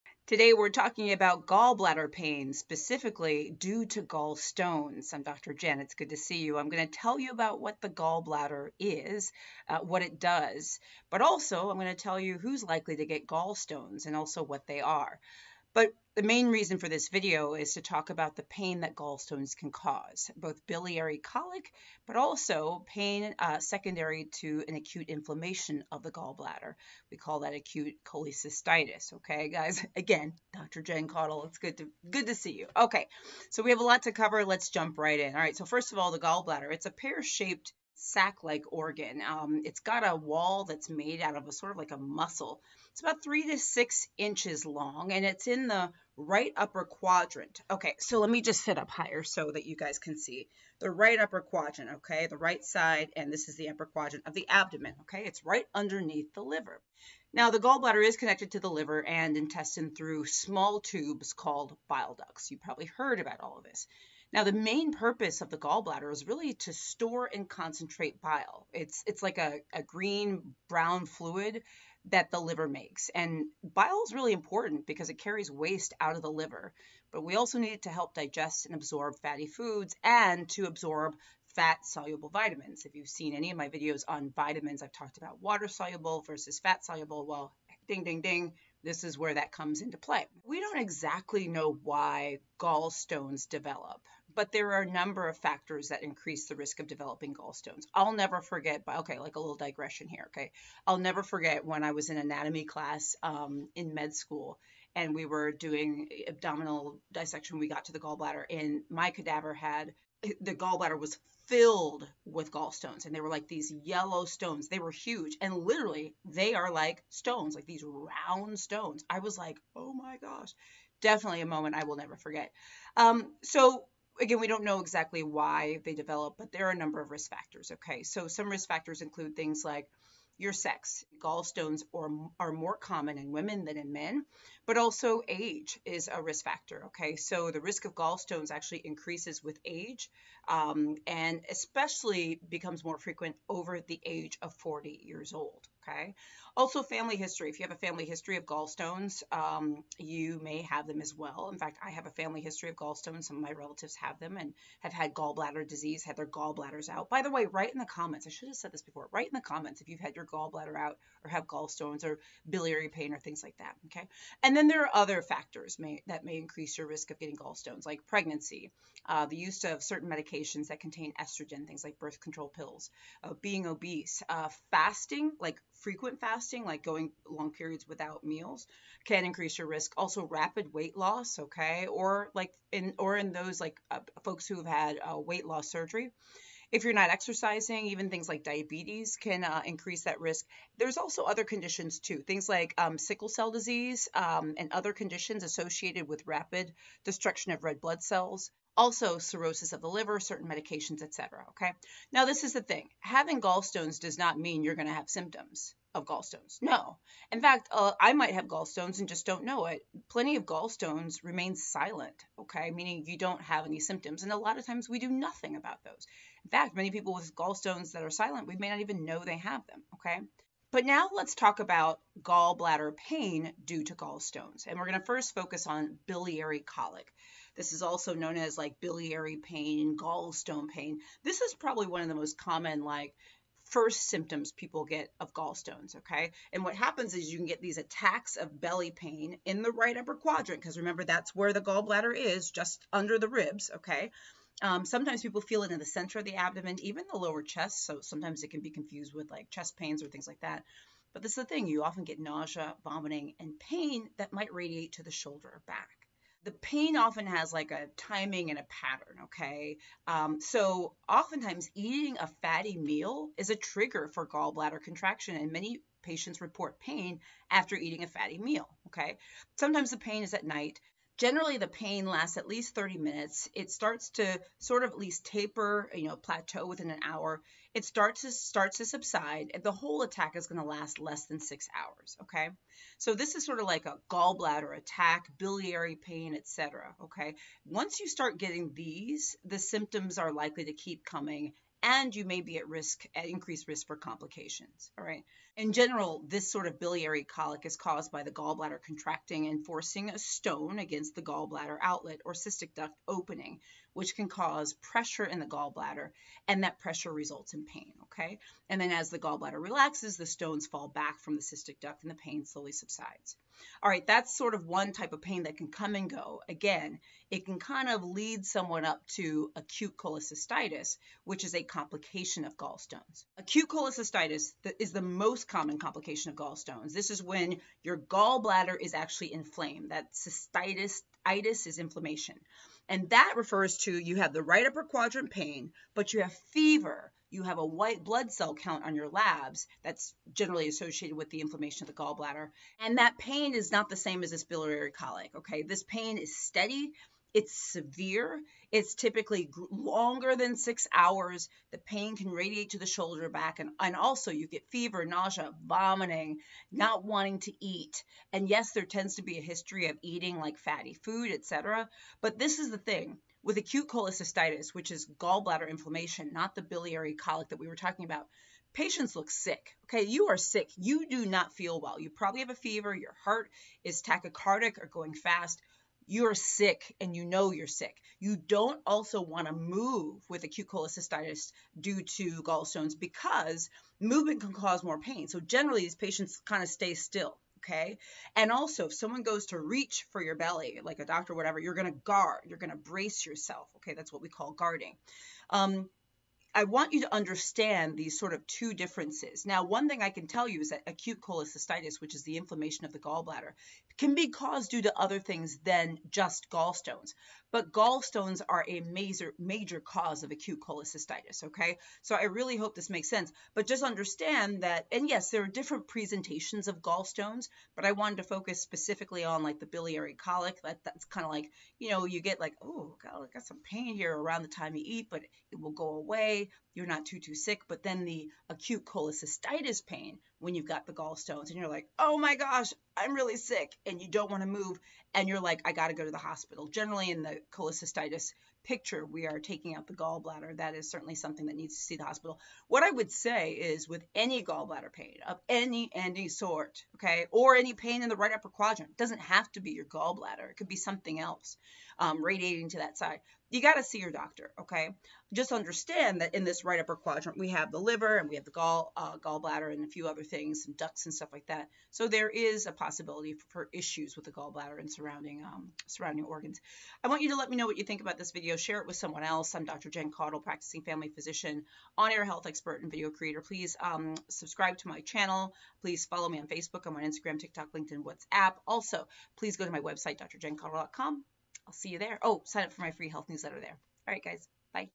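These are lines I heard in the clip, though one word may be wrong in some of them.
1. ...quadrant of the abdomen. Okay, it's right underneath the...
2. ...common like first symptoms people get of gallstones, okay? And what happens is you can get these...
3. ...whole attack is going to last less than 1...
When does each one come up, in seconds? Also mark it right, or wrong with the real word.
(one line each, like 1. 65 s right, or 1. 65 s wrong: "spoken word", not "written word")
1. 53 s right
2. 232 s right
3. 279 s wrong: "6", not "1".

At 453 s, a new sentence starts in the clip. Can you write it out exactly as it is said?
You got to see your doctor, okay?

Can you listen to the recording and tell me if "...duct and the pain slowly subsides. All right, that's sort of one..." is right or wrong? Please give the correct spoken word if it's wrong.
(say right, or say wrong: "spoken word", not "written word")
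right.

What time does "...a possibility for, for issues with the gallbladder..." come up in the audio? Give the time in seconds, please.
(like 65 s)
462 s.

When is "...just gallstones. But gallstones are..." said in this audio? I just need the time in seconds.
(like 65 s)
406 s.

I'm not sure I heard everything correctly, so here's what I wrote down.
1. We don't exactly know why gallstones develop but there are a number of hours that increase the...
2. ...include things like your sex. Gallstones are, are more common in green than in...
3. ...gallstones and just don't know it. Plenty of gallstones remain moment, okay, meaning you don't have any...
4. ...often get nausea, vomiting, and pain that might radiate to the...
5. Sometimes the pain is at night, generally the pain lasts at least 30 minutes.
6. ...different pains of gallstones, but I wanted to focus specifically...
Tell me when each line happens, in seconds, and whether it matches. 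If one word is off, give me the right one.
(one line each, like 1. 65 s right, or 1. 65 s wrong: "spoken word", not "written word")
1. 90 s wrong: "factors", not "hours"
2. 129 s wrong: "women", not "green"
3. 208 s wrong: "silent", not "moment"
4. 251 s right
5. 269 s right
6. 415 s wrong: "presentations", not "pains".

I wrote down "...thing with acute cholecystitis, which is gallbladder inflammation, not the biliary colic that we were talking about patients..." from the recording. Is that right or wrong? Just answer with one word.
right.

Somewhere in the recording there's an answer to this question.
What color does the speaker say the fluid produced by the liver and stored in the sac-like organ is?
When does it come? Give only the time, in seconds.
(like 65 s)
69 s.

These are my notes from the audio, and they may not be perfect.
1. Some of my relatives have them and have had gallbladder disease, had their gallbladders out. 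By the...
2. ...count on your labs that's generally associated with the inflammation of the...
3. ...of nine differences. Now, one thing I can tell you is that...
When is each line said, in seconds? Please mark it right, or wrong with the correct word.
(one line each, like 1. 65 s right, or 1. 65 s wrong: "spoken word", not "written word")
1. 153 s right
2. 338 s right
3. 398 s wrong: "two", not "nine".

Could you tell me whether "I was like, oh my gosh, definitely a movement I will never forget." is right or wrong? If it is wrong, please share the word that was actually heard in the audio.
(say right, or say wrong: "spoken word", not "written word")
wrong: "moment", not "movement".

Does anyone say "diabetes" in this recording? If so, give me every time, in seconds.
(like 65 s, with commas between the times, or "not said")
188 s.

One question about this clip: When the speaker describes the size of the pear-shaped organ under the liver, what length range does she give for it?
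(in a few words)
3 to 6 inches.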